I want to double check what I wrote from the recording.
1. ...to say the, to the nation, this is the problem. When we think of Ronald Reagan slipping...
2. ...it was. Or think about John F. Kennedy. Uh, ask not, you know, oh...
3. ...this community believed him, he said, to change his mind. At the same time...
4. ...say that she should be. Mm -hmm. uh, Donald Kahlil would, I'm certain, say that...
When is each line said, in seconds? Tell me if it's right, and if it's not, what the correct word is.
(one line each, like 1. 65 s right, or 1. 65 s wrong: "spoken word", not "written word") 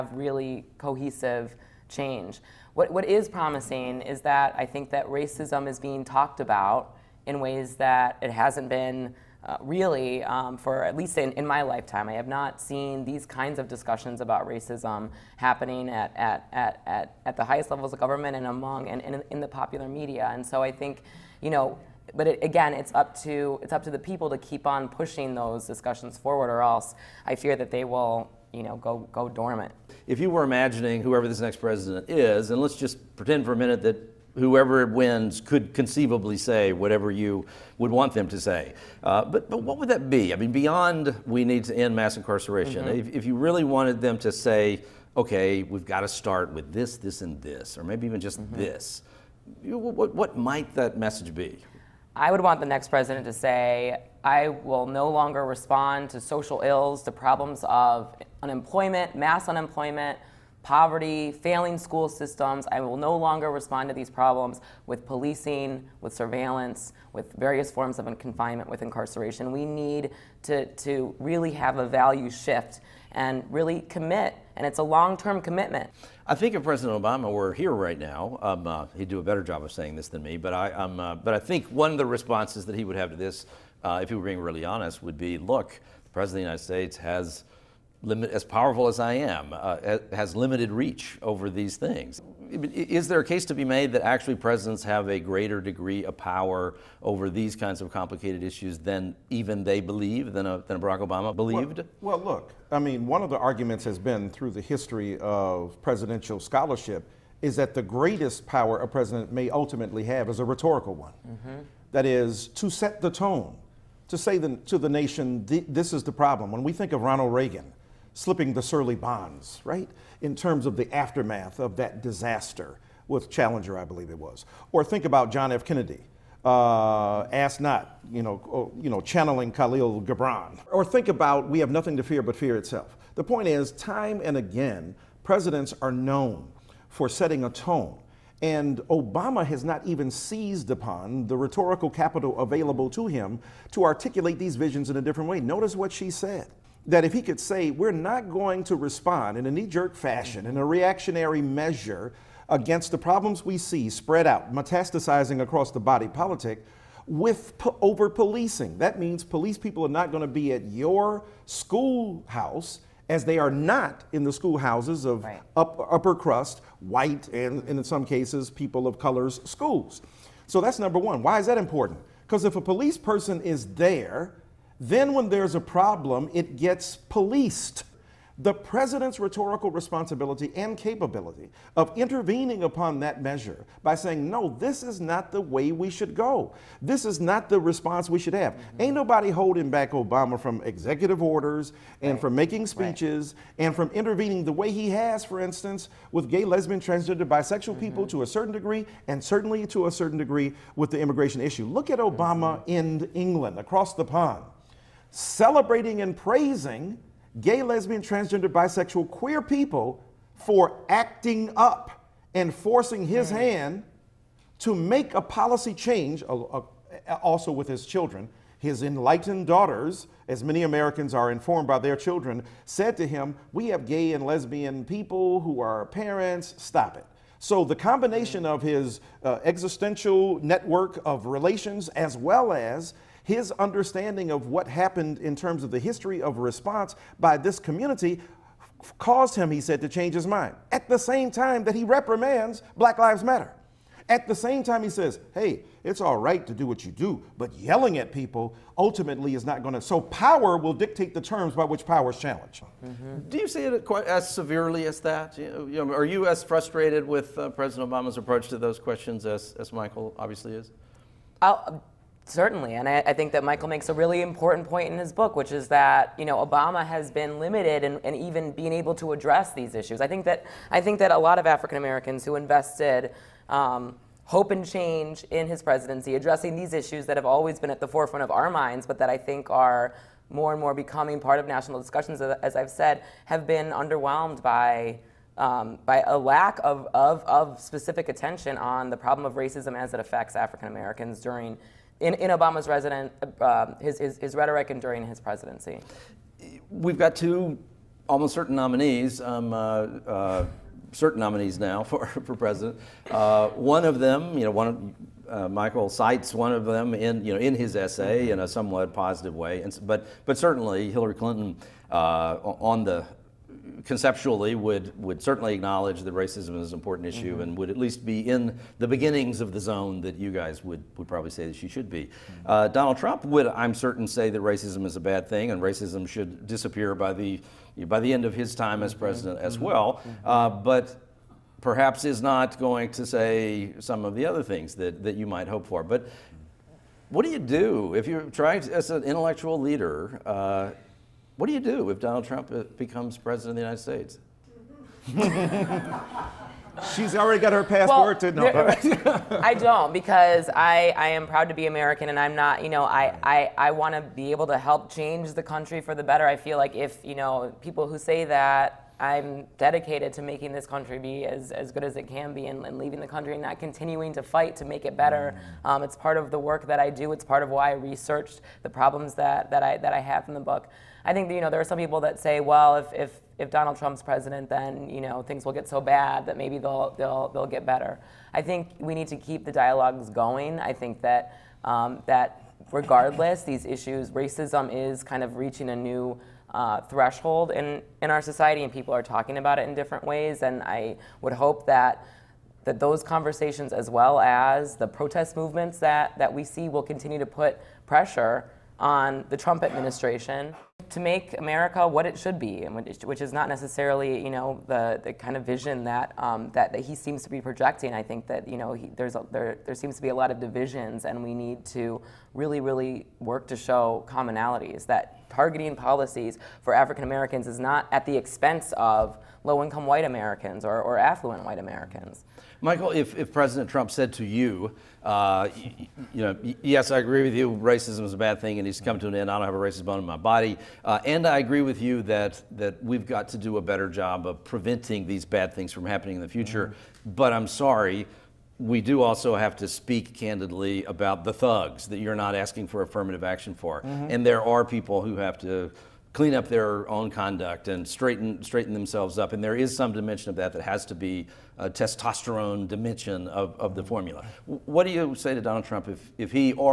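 1. 114 s right
2. 124 s right
3. 237 s wrong: "caused", not "believed"
4. 321 s wrong: "Trump", not "Kahlil".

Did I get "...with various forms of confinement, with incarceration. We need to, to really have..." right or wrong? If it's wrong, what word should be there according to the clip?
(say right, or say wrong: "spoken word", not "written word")
right.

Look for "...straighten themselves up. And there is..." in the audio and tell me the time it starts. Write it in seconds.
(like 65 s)
448 s.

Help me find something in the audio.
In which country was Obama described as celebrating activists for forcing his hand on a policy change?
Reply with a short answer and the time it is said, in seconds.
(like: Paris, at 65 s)
England, at 203 s.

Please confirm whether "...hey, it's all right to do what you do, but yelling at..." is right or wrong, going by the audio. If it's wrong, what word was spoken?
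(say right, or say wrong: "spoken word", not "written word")
right.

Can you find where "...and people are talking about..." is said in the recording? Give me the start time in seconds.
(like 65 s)
388 s.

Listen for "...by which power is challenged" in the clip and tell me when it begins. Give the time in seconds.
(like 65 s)
251 s.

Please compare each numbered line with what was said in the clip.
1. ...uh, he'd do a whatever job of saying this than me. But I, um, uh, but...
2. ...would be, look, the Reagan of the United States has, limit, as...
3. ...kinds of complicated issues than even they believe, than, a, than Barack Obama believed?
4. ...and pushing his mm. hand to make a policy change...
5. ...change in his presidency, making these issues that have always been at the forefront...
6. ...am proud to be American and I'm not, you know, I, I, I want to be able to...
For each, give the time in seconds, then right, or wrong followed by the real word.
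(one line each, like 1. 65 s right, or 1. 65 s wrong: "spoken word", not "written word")
1. 78 s wrong: "better", not "whatever"
2. 85 s wrong: "President", not "Reagan"
3. 97 s right
4. 212 s wrong: "forcing", not "pushing"
5. 274 s wrong: "addressing", not "making"
6. 351 s right.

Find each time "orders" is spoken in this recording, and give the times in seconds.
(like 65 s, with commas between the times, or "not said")
191 s.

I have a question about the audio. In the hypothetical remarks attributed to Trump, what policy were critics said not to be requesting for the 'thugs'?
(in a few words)
affirmative action.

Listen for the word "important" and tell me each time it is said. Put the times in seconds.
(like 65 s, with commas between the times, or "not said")
171 s, 264 s, 316 s.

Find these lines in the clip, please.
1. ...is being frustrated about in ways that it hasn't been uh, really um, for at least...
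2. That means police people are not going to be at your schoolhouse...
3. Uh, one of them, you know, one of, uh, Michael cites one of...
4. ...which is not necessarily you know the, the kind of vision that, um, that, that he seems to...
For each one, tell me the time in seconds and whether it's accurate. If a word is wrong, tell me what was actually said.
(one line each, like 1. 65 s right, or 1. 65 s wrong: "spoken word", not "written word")
1. 5 s wrong: "talked", not "frustrated"
2. 158 s right
3. 303 s right
4. 402 s right.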